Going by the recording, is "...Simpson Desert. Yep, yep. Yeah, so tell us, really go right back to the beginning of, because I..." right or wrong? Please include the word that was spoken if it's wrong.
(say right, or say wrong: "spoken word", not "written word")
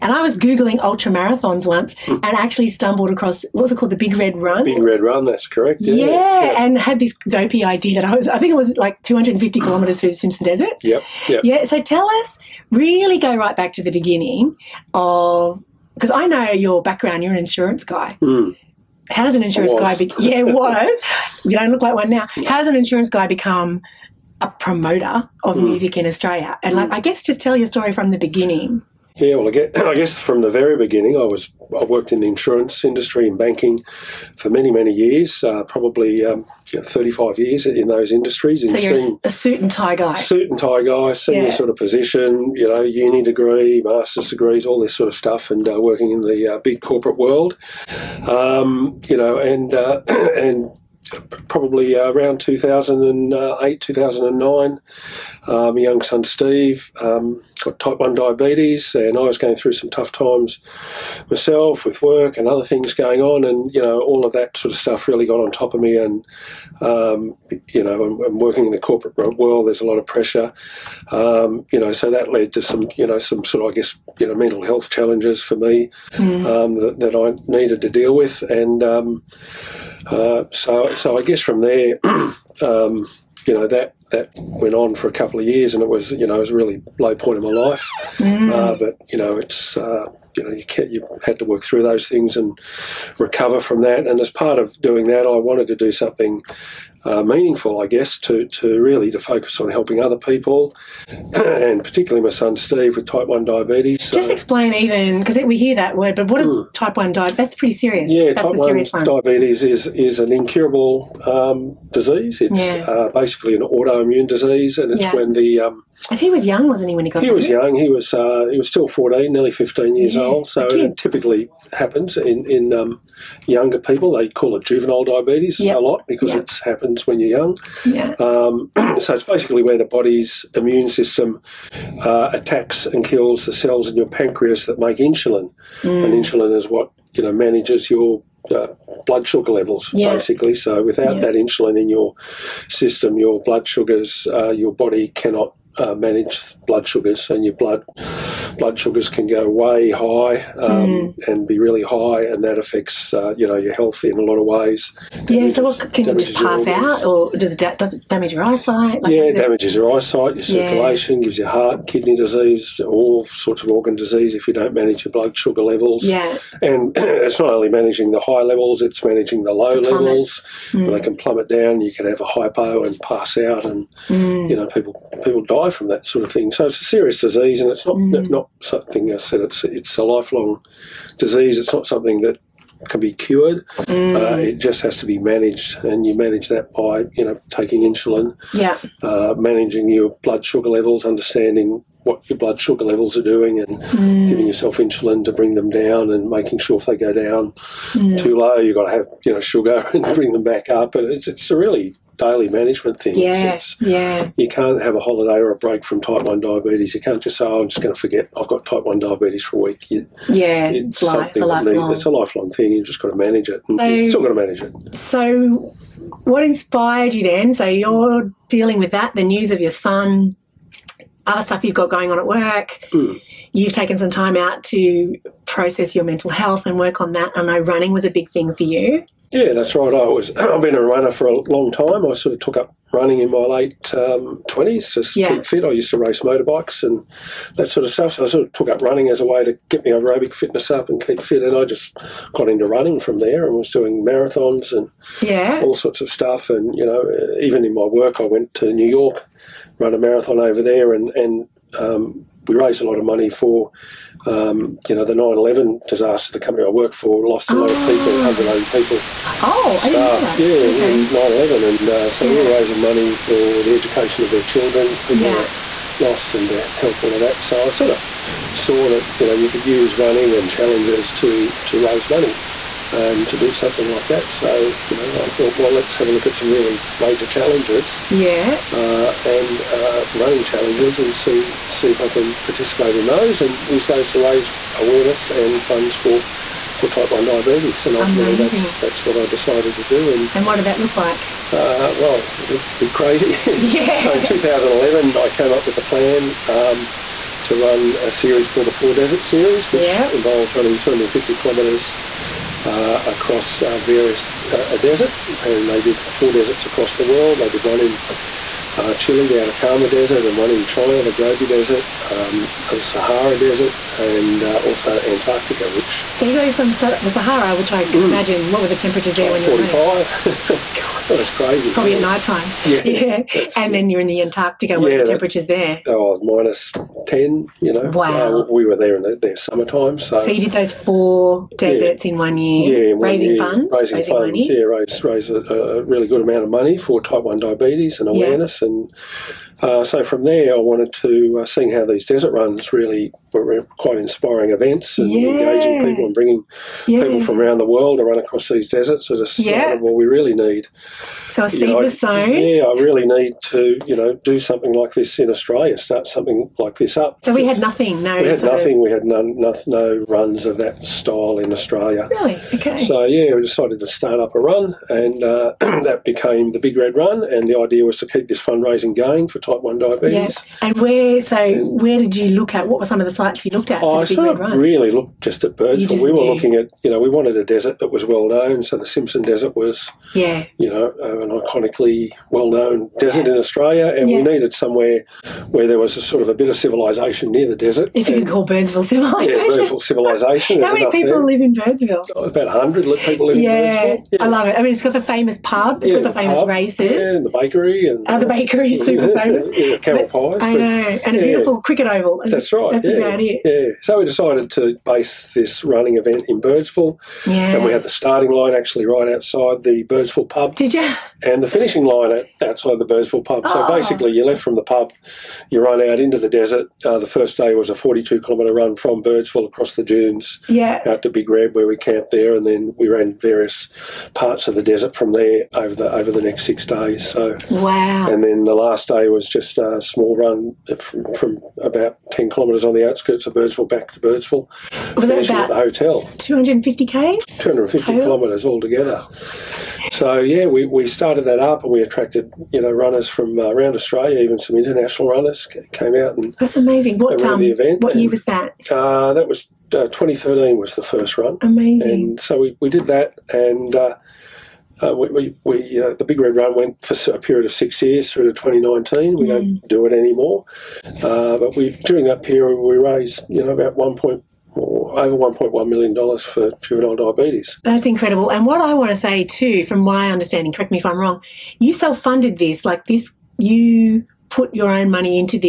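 right.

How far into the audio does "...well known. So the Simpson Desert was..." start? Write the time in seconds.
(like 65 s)
378 s.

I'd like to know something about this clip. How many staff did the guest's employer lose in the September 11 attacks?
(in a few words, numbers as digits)
180.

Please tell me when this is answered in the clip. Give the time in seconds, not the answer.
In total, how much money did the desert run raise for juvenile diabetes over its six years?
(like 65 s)
464 s.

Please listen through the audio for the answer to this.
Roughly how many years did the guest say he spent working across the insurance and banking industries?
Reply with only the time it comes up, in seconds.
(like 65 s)
36 s.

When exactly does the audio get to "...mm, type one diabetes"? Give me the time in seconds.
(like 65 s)
106 s.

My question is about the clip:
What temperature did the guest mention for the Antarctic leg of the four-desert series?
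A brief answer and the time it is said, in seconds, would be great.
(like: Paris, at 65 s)
Minus 10, at 326 s.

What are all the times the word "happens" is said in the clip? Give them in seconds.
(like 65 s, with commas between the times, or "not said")
121 s, 126 s.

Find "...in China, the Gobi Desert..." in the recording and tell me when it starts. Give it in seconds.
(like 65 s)
310 s.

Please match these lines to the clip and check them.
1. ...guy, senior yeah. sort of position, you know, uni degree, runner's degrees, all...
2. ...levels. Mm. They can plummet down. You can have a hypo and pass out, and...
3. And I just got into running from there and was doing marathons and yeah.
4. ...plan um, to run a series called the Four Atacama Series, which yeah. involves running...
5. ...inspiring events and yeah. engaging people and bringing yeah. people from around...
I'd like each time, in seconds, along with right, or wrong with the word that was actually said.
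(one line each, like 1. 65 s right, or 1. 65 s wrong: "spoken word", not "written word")
1. 40 s wrong: "master", not "runner"
2. 169 s right
3. 241 s right
4. 295 s wrong: "Desert", not "Atacama"
5. 343 s right.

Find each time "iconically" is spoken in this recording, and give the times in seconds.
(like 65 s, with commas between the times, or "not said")
381 s.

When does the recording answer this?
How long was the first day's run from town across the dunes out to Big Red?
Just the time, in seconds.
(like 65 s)
417 s.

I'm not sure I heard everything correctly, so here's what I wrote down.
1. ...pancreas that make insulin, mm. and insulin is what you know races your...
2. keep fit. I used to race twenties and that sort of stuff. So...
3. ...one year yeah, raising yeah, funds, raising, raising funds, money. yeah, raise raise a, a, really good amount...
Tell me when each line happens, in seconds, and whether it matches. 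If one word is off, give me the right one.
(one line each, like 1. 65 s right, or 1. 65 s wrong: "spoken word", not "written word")
1. 134 s wrong: "manages", not "races"
2. 235 s wrong: "motorbikes", not "twenties"
3. 332 s right.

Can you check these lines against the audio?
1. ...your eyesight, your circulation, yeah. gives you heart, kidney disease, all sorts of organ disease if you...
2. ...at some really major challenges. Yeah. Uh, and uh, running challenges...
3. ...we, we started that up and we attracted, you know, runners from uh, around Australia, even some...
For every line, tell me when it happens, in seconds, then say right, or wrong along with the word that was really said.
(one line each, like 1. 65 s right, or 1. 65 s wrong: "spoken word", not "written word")
1. 159 s right
2. 276 s right
3. 440 s right.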